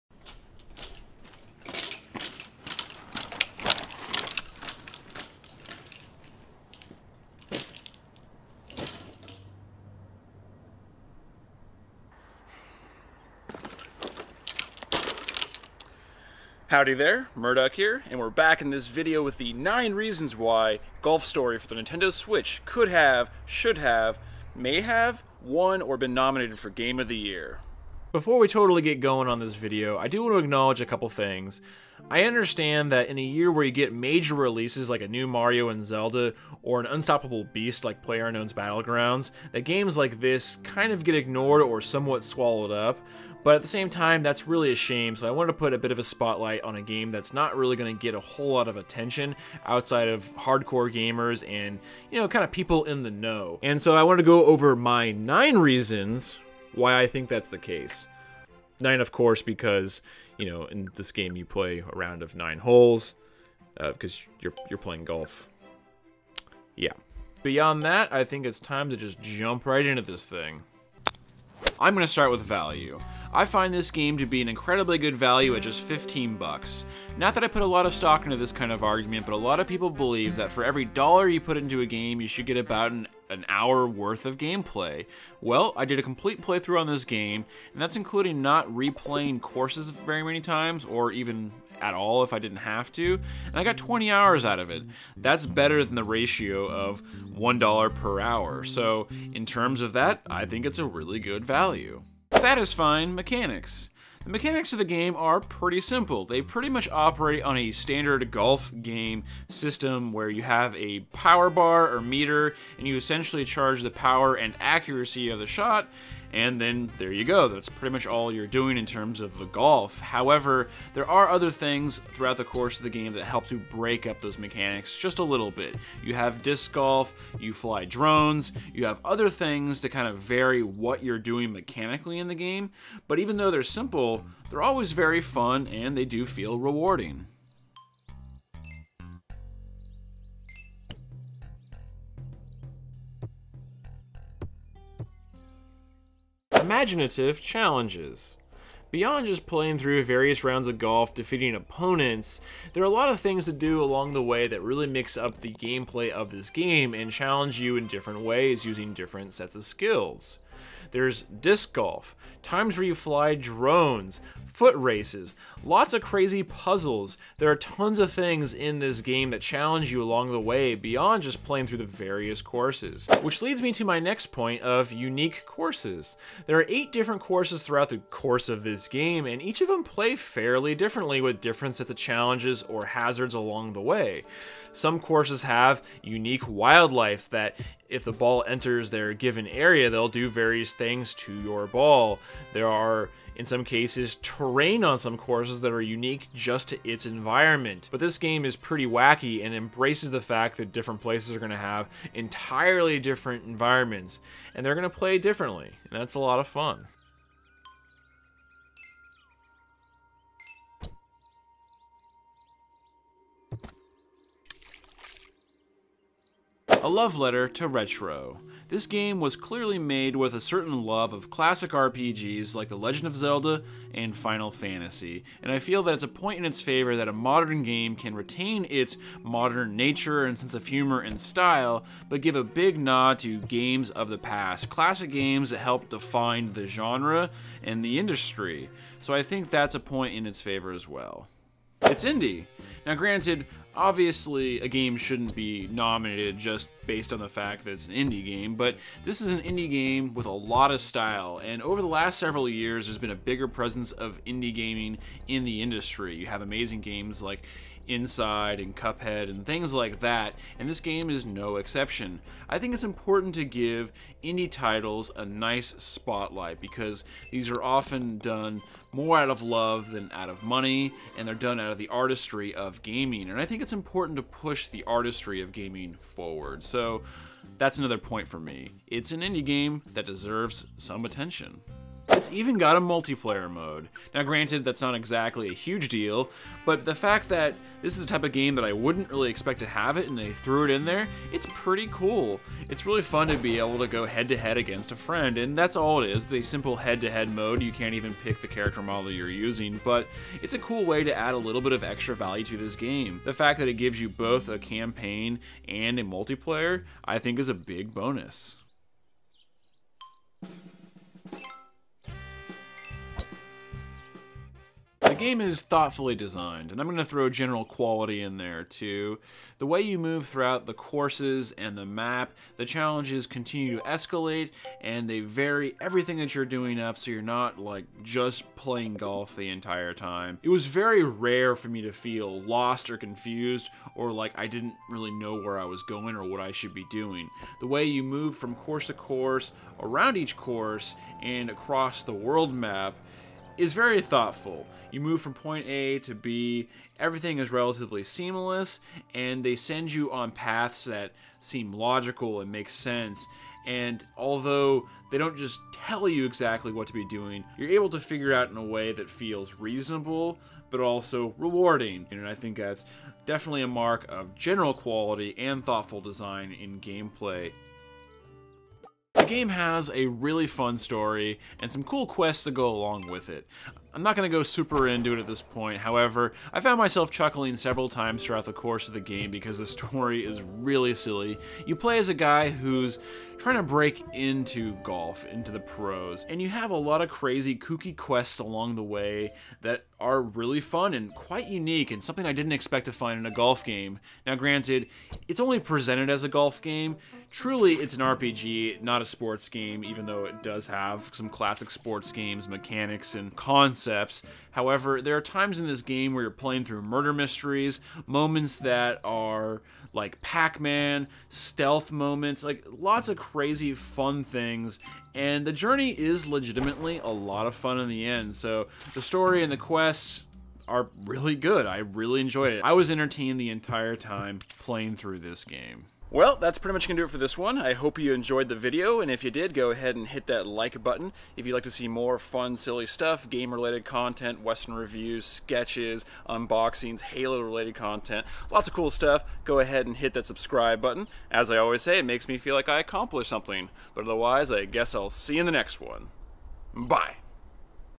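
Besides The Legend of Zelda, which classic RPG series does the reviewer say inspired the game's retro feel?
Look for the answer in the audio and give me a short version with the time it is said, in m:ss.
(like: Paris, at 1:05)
Final Fantasy, at 3:44.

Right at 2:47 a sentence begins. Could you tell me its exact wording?
There are tons of things in this game that challenge you along the way beyond just playing through the various courses.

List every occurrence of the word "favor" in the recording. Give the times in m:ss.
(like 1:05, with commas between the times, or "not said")
3:46, 4:00.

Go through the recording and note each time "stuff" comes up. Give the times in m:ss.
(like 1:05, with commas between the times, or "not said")
7:12, 7:18.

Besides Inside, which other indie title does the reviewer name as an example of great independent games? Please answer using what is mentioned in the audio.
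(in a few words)
Cuphead.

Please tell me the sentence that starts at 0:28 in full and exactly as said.
Before we totally get going on this video, I do want to acknowledge a couple things.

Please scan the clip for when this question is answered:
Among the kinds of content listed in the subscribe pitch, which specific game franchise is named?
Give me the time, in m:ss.
7:17.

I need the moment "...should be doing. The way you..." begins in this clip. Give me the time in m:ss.
5:36.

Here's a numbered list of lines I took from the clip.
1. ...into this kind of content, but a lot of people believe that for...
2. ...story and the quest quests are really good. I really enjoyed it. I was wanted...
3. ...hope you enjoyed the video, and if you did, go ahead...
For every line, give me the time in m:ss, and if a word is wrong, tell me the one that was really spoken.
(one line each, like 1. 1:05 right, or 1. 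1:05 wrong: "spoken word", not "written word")
1. 1:18 wrong: "argument", not "content"
2. 6:59 wrong: "entertained", not "wanted"
3. 7:07 right.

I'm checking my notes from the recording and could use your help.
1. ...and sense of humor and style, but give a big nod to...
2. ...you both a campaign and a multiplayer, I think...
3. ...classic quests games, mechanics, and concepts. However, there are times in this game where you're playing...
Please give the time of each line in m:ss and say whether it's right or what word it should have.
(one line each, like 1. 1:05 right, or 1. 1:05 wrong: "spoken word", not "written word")
1. 3:50 right
2. 5:03 right
3. 6:41 wrong: "sports", not "quests".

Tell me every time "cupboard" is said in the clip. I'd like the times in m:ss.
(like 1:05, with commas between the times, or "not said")
not said.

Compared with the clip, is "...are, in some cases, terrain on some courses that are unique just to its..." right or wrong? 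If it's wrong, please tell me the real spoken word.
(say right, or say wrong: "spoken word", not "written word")
right.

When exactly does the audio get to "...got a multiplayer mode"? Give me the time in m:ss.
4:42.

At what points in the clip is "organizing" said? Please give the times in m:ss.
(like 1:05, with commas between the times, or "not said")
not said.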